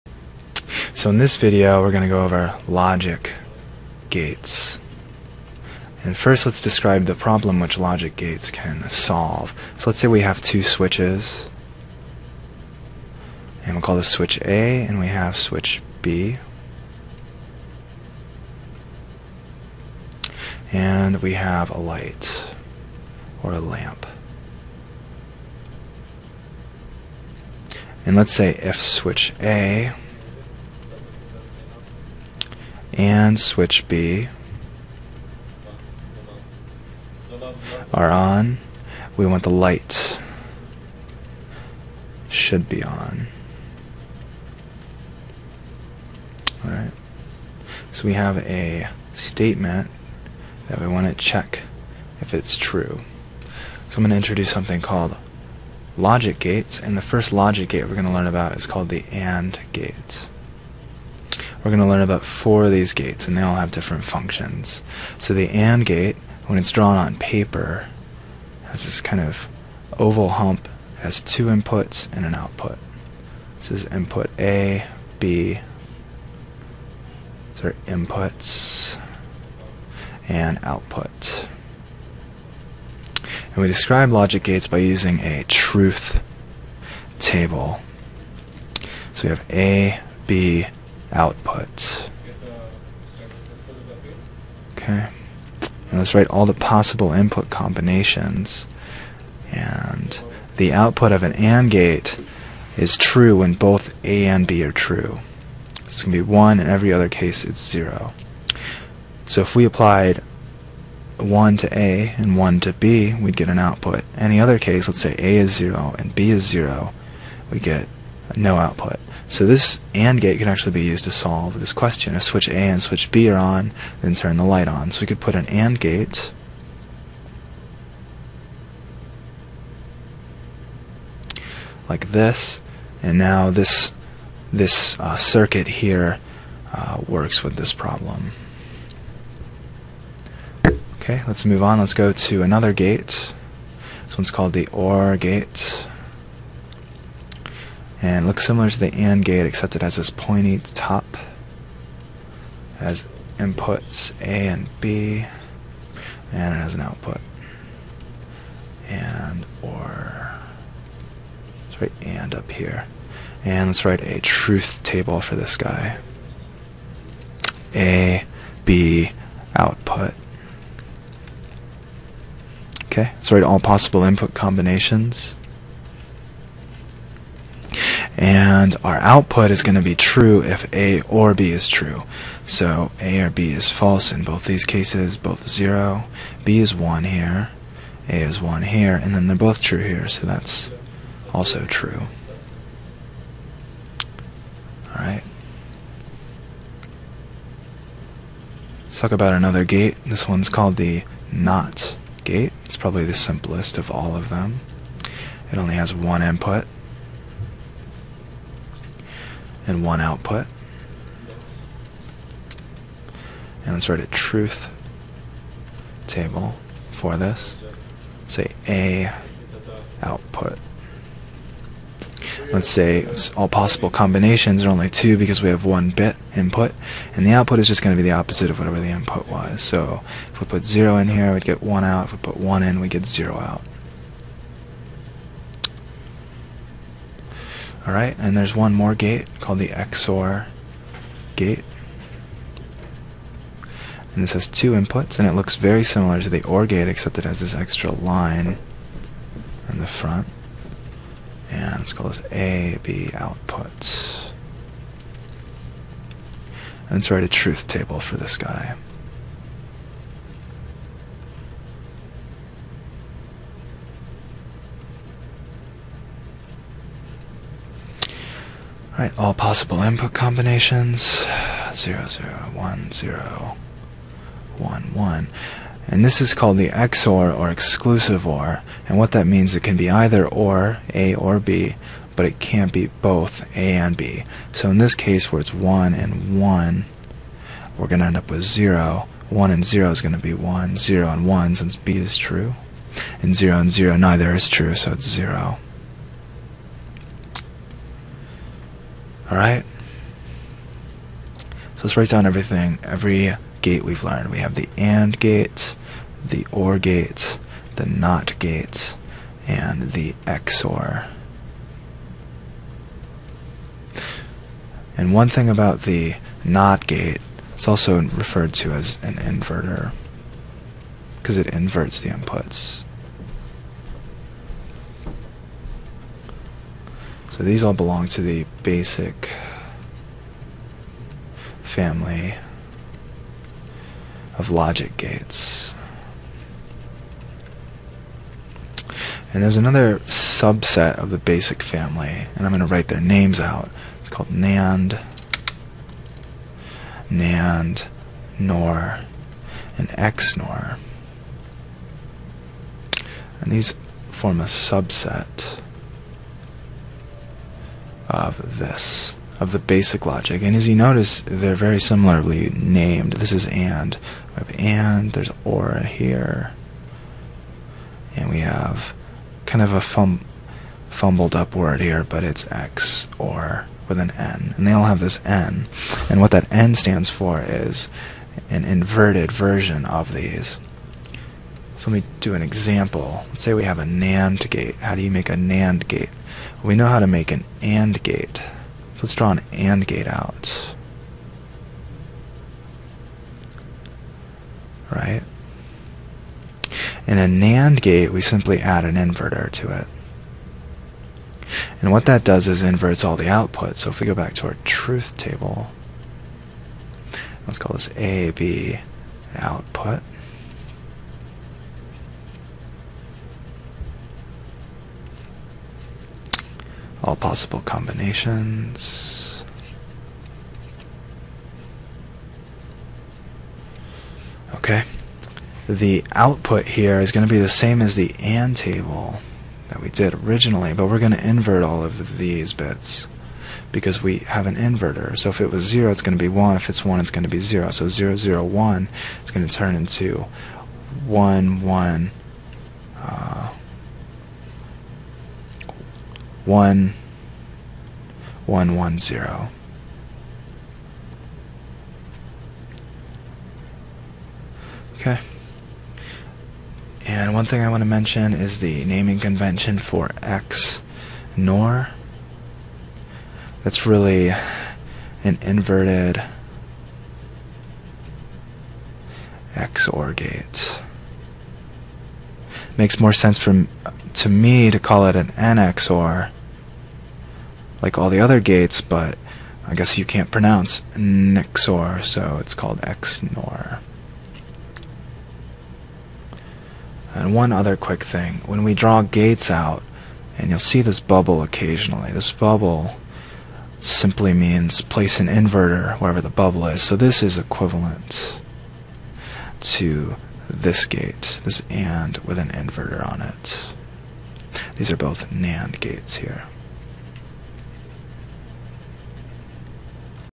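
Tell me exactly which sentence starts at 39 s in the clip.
We want the light should be on.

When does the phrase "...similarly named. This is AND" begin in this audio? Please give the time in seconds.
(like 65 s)
361 s.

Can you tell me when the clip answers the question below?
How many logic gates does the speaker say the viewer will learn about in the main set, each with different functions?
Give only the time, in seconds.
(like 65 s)
62 s.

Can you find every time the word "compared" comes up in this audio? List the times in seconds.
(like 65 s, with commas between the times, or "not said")
not said.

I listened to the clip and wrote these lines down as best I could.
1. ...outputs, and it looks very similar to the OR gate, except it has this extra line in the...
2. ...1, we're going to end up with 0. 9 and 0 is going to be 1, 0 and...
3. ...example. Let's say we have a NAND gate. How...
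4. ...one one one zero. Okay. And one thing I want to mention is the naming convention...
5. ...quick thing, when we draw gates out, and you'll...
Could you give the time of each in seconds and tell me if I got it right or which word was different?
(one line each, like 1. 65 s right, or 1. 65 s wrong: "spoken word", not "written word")
1. 244 s wrong: "inputs", not "outputs"
2. 286 s wrong: "1", not "9"
3. 382 s right
4. 446 s right
5. 487 s right.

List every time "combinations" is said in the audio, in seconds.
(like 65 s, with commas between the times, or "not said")
97 s, 174 s, 223 s, 270 s, 417 s.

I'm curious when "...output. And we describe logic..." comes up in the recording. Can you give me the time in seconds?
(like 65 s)
80 s.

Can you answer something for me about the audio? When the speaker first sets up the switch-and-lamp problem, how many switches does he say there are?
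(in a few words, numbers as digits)
2.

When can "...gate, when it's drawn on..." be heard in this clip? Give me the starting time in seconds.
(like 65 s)
65 s.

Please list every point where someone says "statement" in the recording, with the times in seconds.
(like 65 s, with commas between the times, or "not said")
49 s.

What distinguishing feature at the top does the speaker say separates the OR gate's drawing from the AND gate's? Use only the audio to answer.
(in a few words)
pointy top.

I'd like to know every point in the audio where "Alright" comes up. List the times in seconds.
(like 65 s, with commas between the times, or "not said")
46 s, 194 s, 237 s.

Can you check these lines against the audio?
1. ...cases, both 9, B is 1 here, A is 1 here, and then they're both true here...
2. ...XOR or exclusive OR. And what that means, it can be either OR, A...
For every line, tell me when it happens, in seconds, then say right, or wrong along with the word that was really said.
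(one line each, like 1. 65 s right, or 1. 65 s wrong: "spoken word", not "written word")
1. 184 s wrong: "0", not "9"
2. 276 s right.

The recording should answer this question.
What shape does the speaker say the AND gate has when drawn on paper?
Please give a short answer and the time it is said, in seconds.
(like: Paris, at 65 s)
oval hump, at 69 s.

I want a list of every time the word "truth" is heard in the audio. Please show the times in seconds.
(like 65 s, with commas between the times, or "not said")
85 s, 164 s, 214 s, 257 s, 404 s.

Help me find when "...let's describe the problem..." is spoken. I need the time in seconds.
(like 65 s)
6 s.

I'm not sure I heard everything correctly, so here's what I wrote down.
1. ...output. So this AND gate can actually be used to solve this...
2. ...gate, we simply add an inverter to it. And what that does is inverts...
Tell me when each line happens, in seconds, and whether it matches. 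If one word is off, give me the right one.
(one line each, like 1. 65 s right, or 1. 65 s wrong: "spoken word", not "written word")
1. 118 s right
2. 397 s right.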